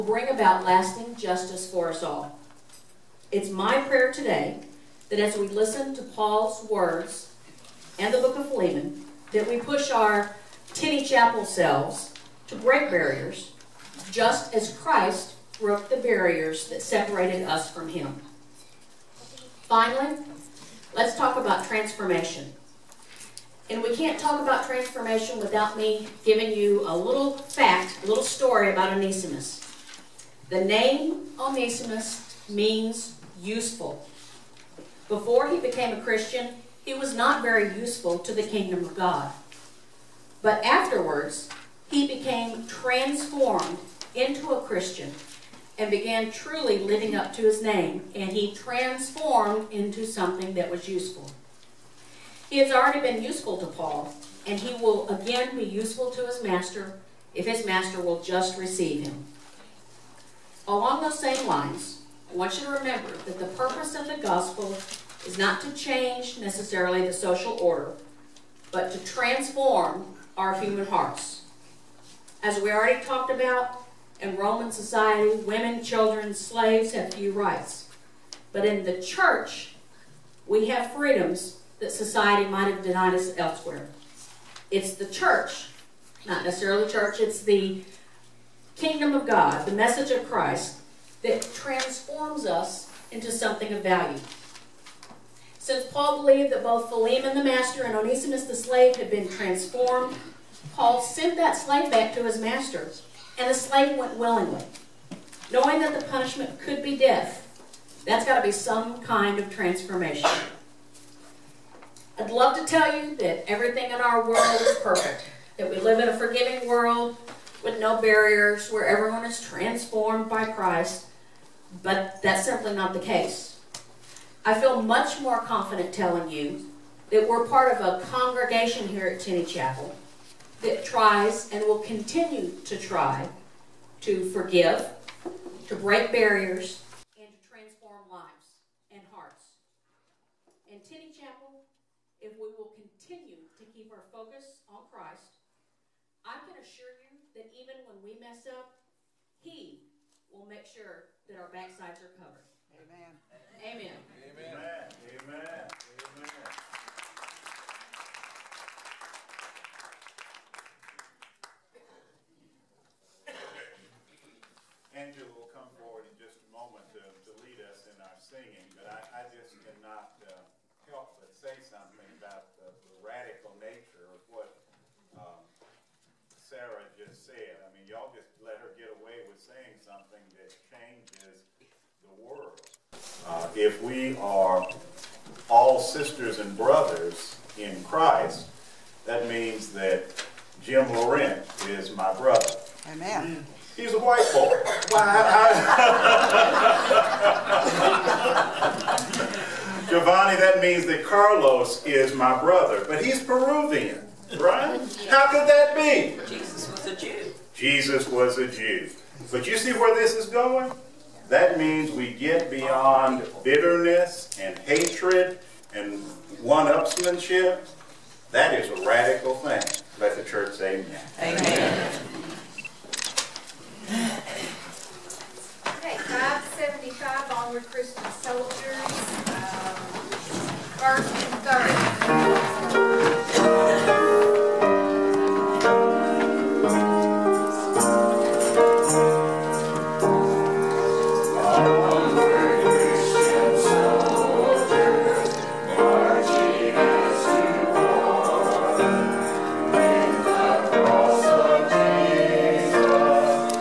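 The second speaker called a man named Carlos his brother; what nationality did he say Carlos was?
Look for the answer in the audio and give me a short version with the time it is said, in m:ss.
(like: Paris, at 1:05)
Peruvian, at 3:23.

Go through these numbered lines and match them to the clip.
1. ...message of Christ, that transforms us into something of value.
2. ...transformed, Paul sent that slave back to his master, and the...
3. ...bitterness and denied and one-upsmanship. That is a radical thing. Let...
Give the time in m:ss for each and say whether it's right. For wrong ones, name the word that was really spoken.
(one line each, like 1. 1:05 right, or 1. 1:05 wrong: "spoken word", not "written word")
1. 1:29 right
2. 1:39 right
3. 3:33 wrong: "hatred", not "denied".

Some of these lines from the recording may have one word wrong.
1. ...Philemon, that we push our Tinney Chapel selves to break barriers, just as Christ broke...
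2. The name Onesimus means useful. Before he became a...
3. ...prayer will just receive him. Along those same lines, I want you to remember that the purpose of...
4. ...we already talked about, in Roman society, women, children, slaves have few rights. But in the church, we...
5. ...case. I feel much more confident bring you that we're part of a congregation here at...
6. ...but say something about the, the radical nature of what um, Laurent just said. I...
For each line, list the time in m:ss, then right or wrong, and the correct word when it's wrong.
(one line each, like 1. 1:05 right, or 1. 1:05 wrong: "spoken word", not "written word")
1. 0:08 right
2. 0:30 right
3. 0:57 wrong: "master", not "prayer"
4. 1:12 right
5. 2:03 wrong: "telling", not "bring"
6. 2:51 wrong: "Sarah", not "Laurent".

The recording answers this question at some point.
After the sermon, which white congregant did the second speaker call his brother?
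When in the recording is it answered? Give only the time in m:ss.
3:10.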